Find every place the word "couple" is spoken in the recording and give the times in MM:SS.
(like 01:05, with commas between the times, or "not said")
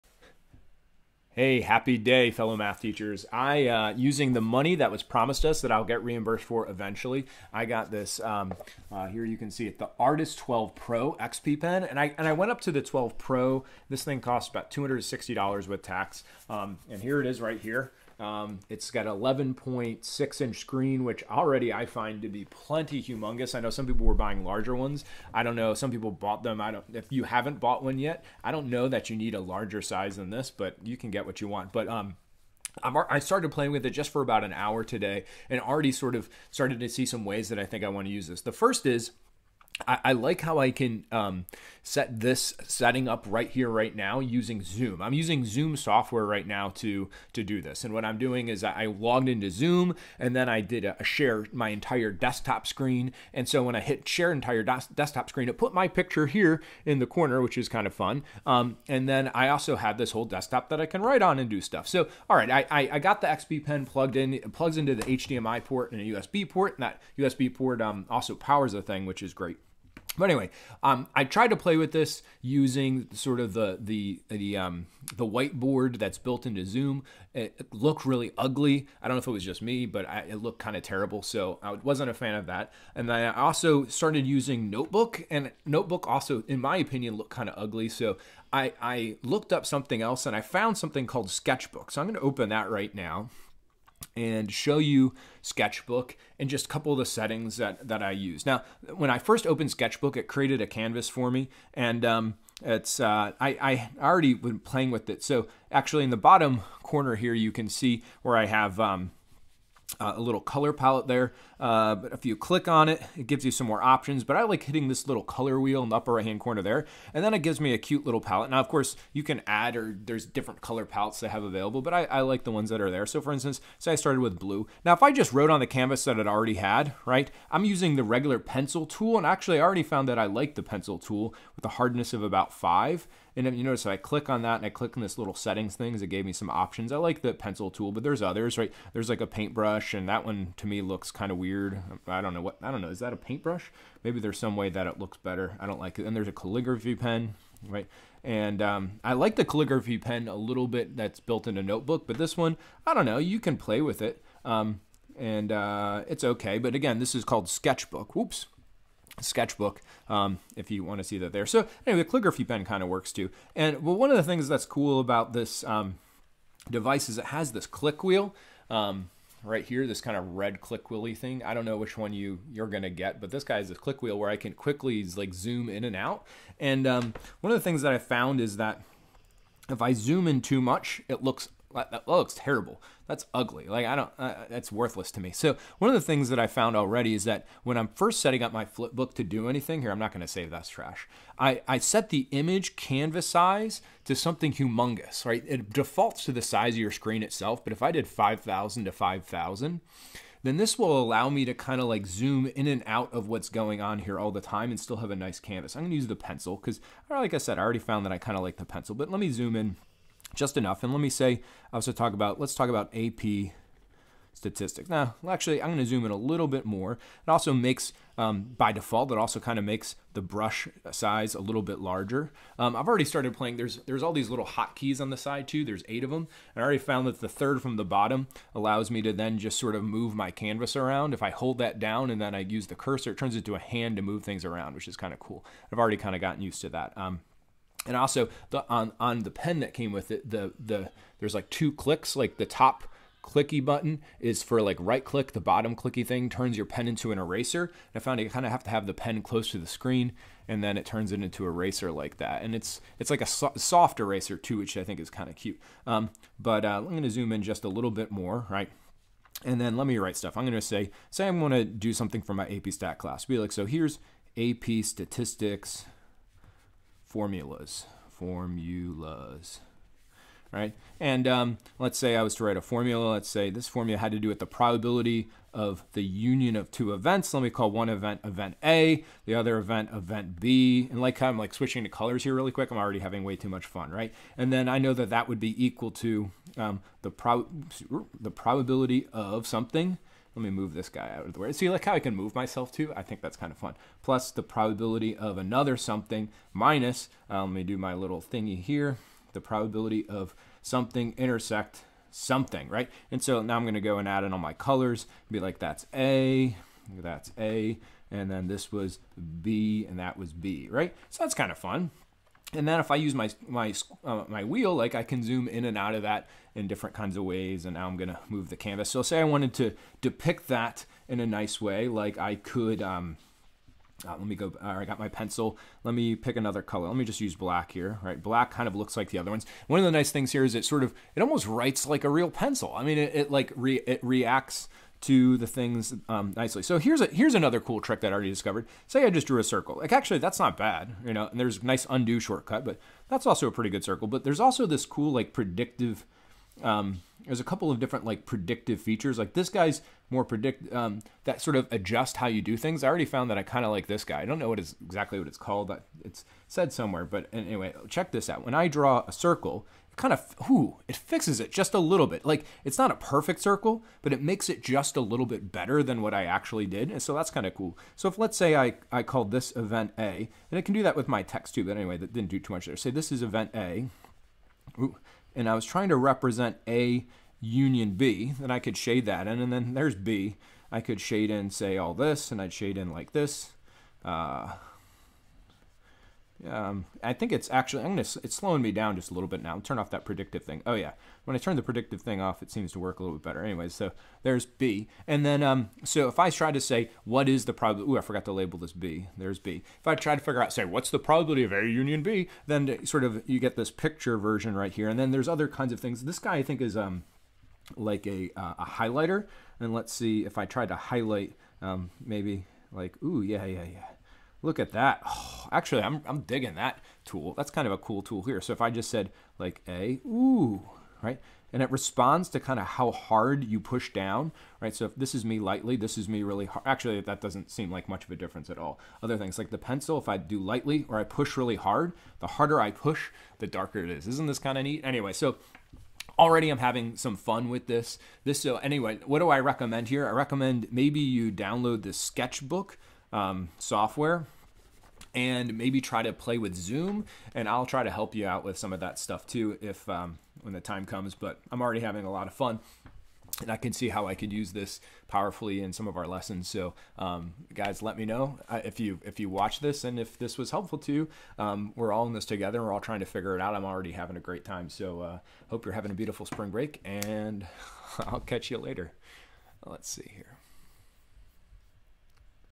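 01:36, 05:47.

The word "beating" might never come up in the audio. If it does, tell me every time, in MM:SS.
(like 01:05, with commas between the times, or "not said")
not said.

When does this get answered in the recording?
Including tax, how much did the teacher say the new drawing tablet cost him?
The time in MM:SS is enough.
00:14.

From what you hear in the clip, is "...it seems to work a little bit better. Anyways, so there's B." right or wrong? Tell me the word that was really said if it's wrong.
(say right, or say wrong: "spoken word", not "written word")
right.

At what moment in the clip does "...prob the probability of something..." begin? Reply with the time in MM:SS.
04:47.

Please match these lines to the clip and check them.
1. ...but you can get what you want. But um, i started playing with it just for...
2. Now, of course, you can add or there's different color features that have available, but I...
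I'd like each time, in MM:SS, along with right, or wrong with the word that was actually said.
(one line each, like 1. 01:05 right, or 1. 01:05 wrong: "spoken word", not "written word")
1. 00:30 right
2. 01:58 wrong: "palettes", not "features".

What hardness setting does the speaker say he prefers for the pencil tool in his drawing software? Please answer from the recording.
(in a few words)
5.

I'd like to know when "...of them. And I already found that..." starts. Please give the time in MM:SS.
03:46.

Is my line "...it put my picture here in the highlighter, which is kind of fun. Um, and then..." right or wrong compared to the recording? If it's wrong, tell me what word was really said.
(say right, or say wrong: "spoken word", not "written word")
wrong: "corner", not "highlighter".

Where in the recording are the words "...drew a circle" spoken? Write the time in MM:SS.
05:39.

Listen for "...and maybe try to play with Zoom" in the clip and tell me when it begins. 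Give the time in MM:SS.
07:25.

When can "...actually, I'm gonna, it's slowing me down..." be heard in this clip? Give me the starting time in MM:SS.
06:27.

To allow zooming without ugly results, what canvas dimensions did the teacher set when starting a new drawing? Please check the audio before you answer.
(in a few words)
5,000 by 5,000.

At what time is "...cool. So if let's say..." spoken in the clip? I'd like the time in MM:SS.
06:07.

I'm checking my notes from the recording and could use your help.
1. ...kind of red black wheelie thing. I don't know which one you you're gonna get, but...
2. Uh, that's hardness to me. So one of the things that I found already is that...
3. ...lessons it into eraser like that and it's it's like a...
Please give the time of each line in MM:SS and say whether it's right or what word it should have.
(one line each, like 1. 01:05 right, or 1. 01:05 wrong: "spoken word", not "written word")
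1. 02:50 wrong: "click", not "black"
2. 03:04 wrong: "worthless", not "hardness"
3. 04:10 wrong: "turns", not "lessons".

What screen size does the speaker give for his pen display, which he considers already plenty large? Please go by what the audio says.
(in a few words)
11.6 inch.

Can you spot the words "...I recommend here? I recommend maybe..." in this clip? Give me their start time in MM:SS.
07:19.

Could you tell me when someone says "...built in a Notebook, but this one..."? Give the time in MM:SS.
02:31.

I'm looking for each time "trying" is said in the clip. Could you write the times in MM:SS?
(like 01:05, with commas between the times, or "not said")
06:15, 07:42.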